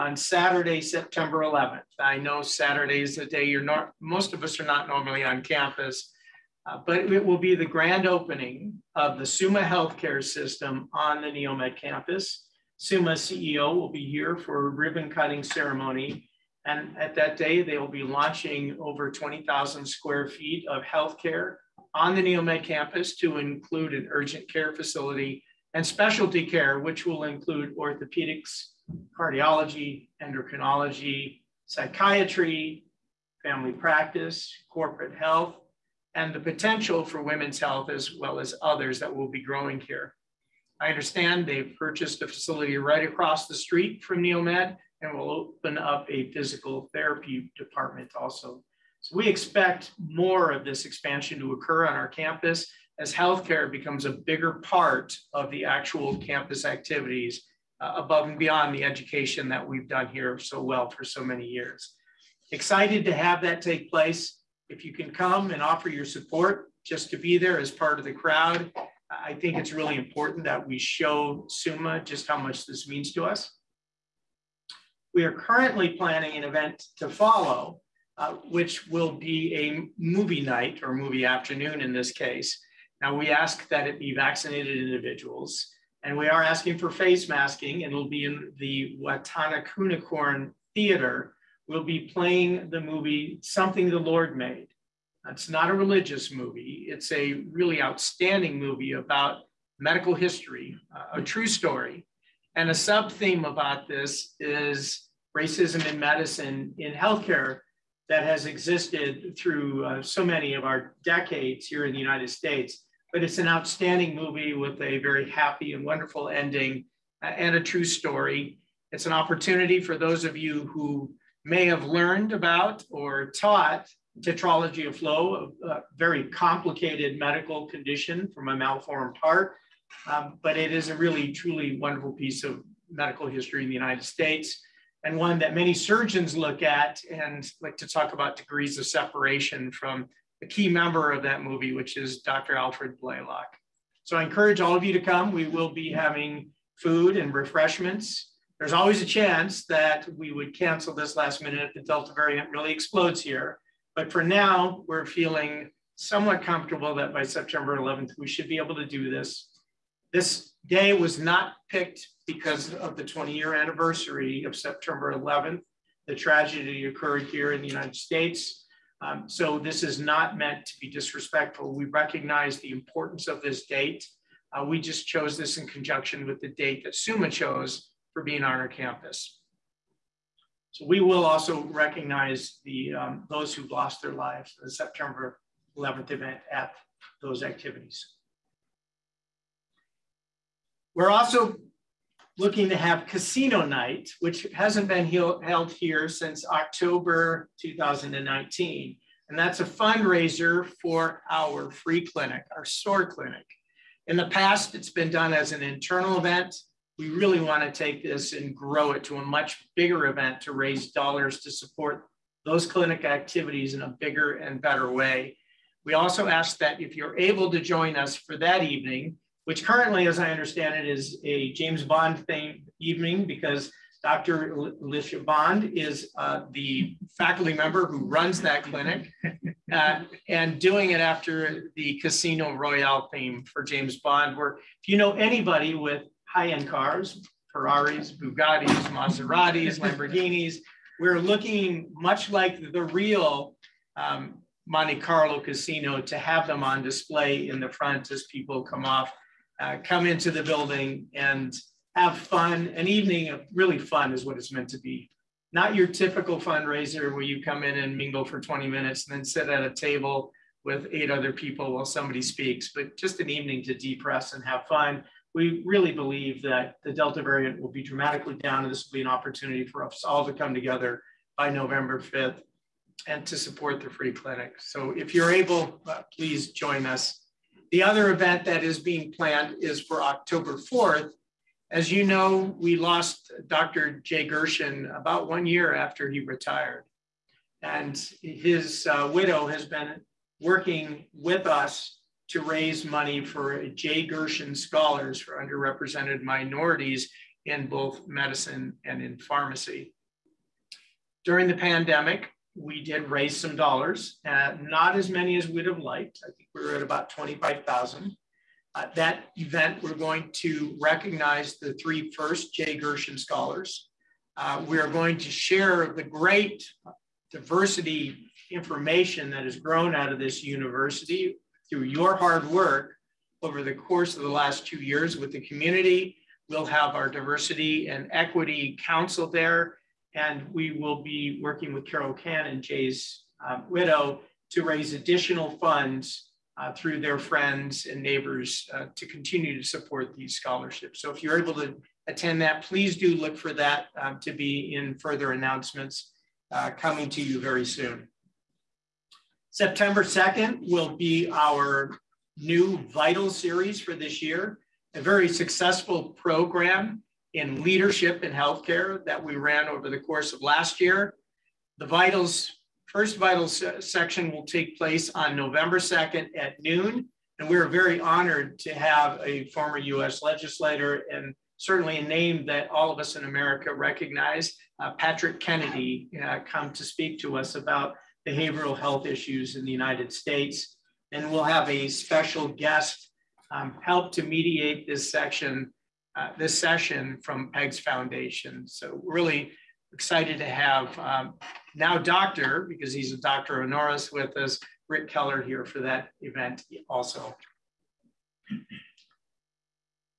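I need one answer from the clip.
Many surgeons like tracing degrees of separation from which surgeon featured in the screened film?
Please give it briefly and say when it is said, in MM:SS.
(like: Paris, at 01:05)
Alfred Blalock, at 02:22.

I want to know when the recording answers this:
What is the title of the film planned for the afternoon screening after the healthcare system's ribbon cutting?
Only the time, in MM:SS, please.
01:33.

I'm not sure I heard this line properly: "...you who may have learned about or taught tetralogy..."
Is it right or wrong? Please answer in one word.
right.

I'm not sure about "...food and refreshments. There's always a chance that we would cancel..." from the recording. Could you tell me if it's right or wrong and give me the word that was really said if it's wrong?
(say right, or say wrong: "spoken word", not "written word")
right.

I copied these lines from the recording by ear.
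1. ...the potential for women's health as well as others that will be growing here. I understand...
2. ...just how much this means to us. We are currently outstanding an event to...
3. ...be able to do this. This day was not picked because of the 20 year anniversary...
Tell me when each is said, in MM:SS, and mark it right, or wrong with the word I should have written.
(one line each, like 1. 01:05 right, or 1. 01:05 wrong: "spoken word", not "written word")
1. 00:36 right
2. 01:12 wrong: "planning", not "outstanding"
3. 02:38 right.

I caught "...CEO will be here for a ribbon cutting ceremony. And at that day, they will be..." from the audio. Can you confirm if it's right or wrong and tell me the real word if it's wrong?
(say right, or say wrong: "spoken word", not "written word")
right.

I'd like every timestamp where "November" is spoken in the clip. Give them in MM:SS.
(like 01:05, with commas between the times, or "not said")
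04:31, 06:05.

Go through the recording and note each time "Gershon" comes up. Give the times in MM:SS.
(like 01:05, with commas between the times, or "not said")
04:44, 04:54, 05:12.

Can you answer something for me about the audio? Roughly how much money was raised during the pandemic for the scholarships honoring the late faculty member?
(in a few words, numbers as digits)
$25,000.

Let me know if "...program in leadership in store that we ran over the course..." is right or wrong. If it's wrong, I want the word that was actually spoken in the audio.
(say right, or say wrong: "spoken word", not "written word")
wrong: "healthcare", not "store".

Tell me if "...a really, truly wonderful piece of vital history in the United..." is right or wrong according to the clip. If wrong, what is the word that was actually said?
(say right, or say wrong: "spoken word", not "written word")
wrong: "medical", not "vital".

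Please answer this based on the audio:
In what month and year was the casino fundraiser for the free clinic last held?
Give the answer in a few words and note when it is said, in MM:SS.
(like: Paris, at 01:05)
October 2019, at 03:16.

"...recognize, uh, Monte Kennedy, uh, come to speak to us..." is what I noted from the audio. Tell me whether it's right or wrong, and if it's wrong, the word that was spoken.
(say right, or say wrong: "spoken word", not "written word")
wrong: "Patrick", not "Monte".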